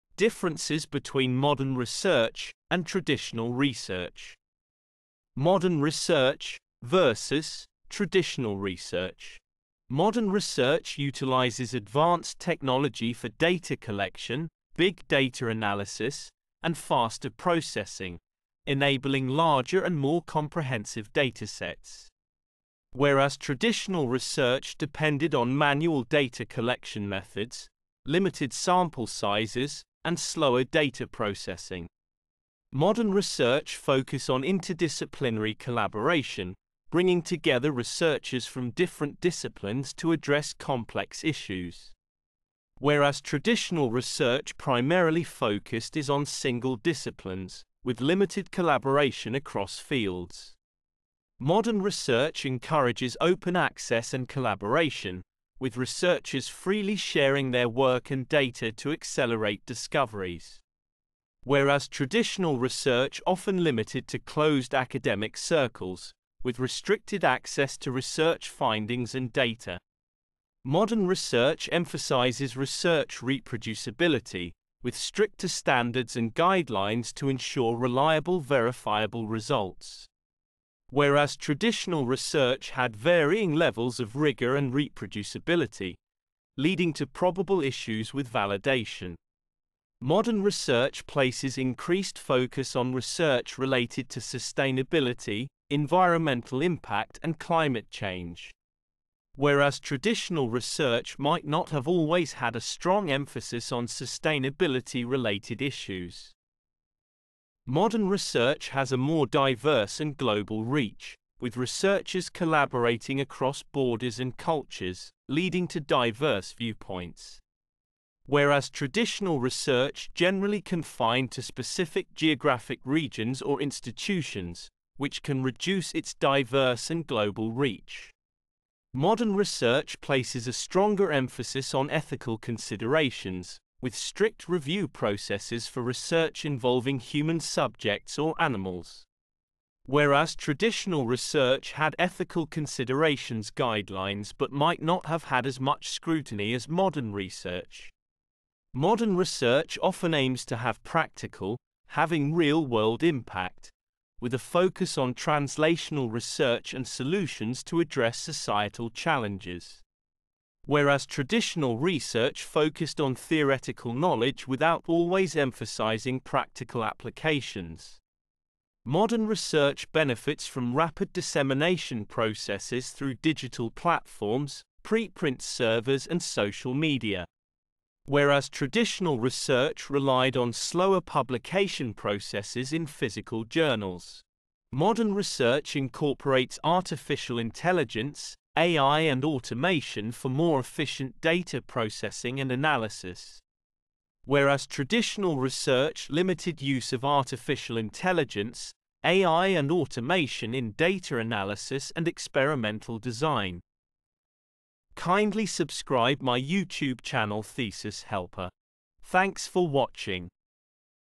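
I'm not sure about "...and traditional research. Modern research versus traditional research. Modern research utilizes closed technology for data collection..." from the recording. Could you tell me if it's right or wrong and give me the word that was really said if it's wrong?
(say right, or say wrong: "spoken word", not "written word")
wrong: "advanced", not "closed".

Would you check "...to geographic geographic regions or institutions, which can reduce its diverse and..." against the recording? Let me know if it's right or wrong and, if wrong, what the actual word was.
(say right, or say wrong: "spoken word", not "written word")
wrong: "specific", not "geographic".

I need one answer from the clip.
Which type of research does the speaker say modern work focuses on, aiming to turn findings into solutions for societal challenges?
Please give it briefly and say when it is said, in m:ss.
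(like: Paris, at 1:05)
translational research, at 2:35.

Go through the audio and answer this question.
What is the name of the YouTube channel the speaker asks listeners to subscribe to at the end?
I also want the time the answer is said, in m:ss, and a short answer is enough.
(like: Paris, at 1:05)
Thesis Helper, at 3:27.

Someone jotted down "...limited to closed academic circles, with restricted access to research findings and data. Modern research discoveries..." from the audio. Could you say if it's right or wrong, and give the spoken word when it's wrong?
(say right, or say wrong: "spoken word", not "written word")
wrong: "emphasizes", not "discoveries".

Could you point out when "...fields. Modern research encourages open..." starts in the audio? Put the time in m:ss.
0:49.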